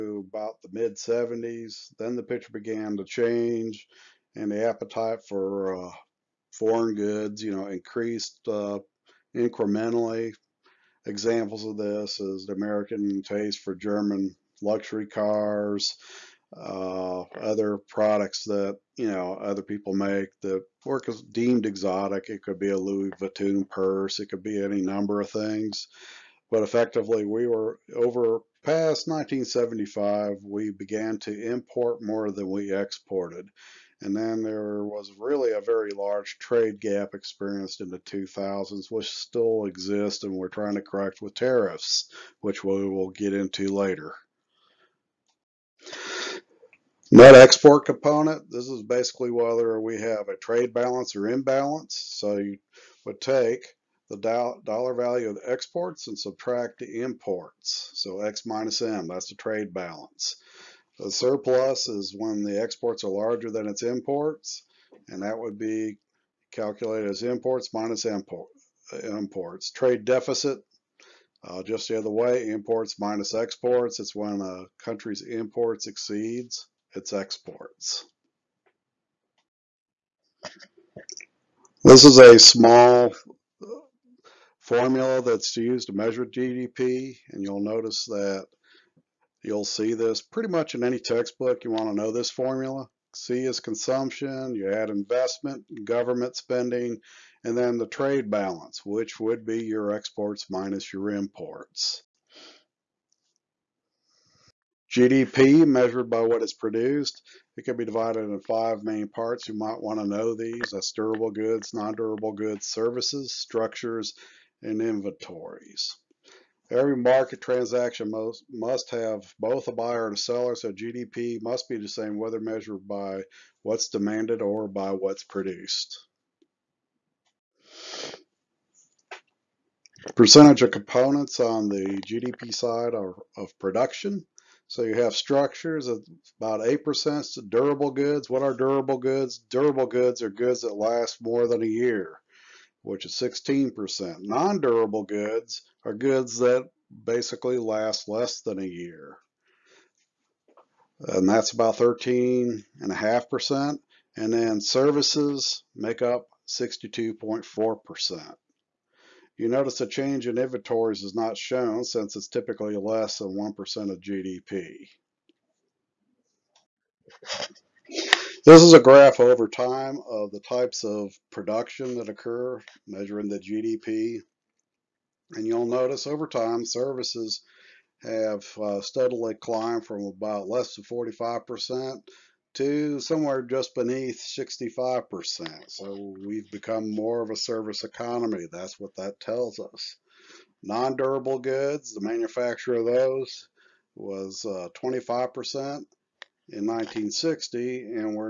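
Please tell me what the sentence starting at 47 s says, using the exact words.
Net export component, this is basically whether we have a trade balance or imbalance.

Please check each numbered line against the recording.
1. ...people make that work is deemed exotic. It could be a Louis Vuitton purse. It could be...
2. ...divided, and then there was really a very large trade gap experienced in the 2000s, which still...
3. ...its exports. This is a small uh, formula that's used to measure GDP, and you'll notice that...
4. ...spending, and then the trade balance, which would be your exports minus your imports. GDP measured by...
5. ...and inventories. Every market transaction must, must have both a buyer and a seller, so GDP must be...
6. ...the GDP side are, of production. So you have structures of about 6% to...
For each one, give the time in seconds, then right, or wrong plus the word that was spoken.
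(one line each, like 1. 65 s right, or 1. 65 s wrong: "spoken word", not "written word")
1. 19 s right
2. 32 s wrong: "exported", not "divided"
3. 76 s right
4. 96 s right
5. 114 s right
6. 131 s wrong: "8", not "6".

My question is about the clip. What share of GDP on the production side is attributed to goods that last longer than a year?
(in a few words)
16%.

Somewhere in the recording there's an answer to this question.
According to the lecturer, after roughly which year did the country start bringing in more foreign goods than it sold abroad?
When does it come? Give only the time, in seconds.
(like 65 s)
29 s.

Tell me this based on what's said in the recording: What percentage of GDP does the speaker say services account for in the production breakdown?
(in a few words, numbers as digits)
62.4%.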